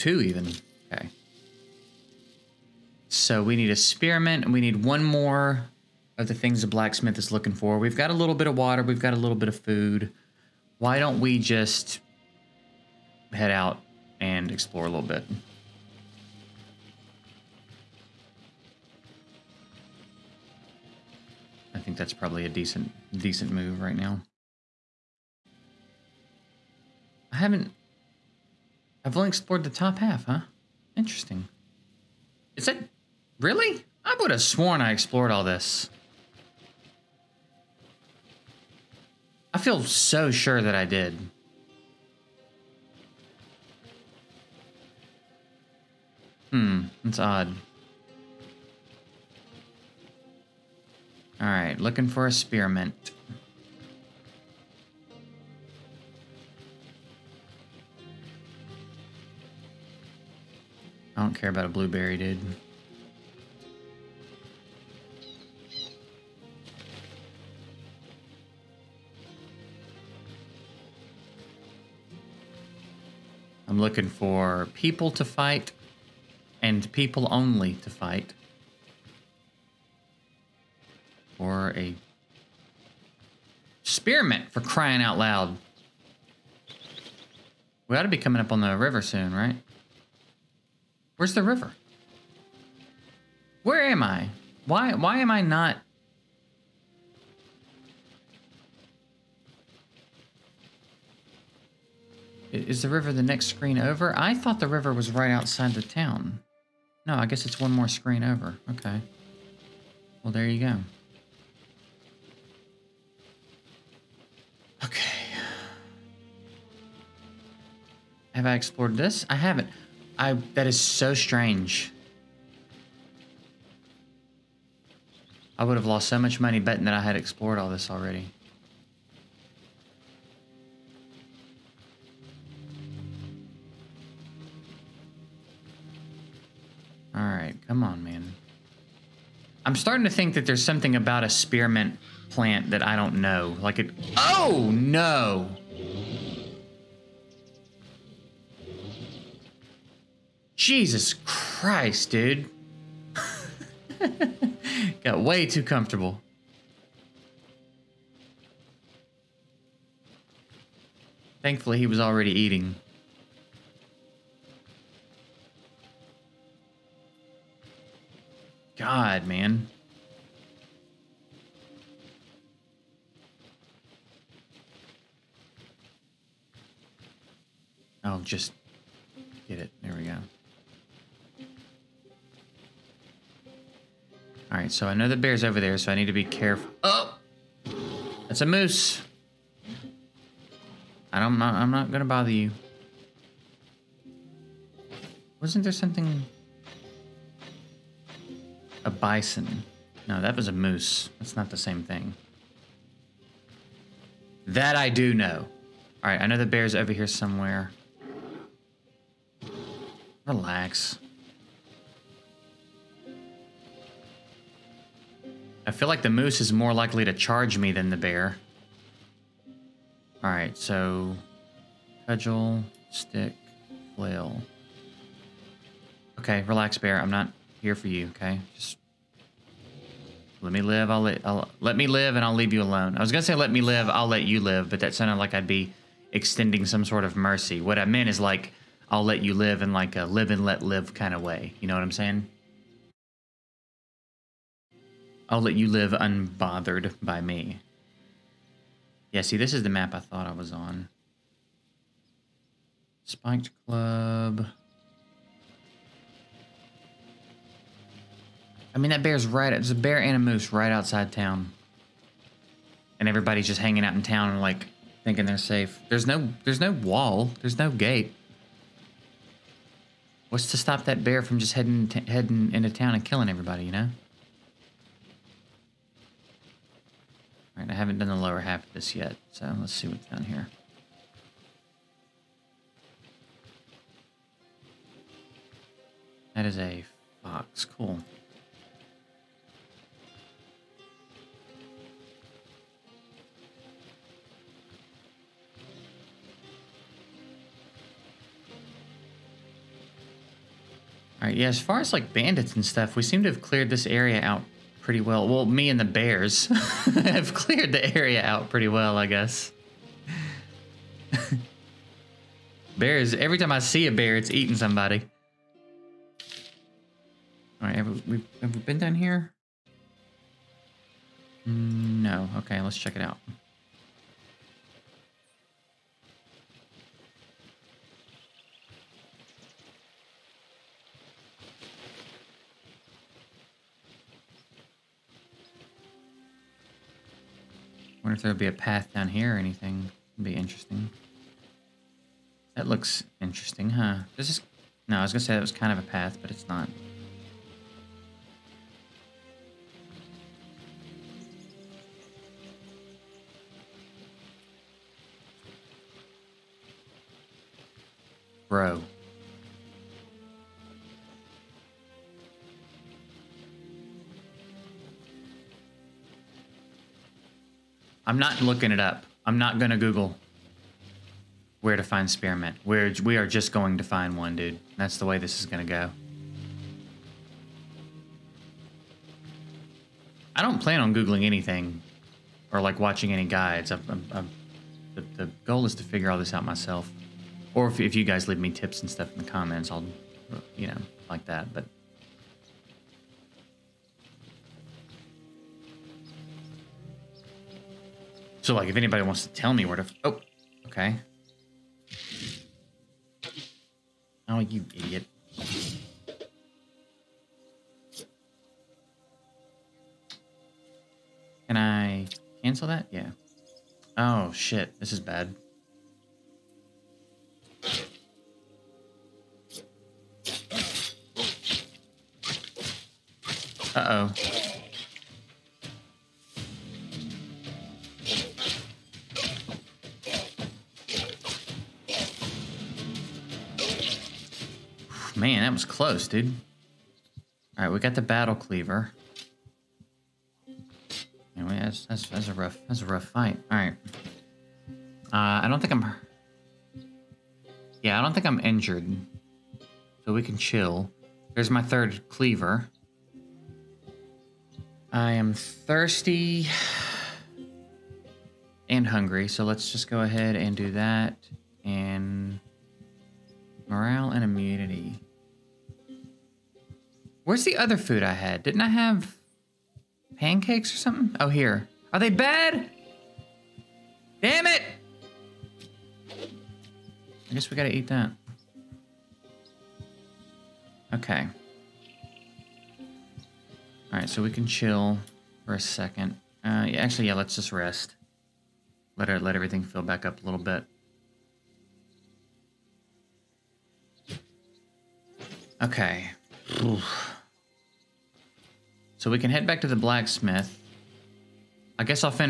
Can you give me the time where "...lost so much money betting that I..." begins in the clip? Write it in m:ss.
2:05.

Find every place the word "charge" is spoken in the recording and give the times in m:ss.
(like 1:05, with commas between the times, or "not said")
3:37.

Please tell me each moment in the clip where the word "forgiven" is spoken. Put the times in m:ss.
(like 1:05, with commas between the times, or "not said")
not said.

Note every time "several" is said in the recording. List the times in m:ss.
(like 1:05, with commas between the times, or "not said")
not said.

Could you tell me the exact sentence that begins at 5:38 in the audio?
if there would be a path down here or anything.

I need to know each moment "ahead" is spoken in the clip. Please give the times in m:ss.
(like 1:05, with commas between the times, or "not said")
7:40.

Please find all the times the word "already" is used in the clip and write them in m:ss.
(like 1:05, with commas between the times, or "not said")
2:07, 2:41.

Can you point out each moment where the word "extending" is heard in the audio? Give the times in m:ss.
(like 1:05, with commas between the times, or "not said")
3:56.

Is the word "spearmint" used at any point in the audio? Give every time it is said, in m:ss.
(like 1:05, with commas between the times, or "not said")
0:03, 0:52, 1:23, 2:21, 6:12.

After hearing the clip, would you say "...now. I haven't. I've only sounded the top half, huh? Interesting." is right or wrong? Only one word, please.
wrong.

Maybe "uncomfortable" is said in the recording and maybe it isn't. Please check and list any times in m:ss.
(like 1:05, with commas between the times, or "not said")
not said.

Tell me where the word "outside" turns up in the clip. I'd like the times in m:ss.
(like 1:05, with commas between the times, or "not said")
1:45, 4:20.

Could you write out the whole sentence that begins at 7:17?
All right, we got the battle cleaver.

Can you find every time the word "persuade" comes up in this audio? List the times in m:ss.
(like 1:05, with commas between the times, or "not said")
not said.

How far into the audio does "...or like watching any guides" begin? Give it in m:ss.
6:22.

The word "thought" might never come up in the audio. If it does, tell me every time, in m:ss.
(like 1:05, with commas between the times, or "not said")
1:44, 4:09.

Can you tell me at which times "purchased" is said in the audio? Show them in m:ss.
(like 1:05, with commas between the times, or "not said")
not said.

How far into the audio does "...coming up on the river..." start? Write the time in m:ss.
1:28.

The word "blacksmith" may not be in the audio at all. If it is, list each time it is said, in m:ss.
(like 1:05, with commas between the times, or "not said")
0:06, 8:19.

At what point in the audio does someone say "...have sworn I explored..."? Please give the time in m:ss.
0:34.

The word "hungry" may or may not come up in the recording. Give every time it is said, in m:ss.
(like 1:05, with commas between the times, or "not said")
7:38.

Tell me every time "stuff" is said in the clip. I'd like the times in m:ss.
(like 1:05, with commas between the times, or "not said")
5:02, 6:28.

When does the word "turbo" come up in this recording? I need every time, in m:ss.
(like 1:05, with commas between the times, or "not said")
not said.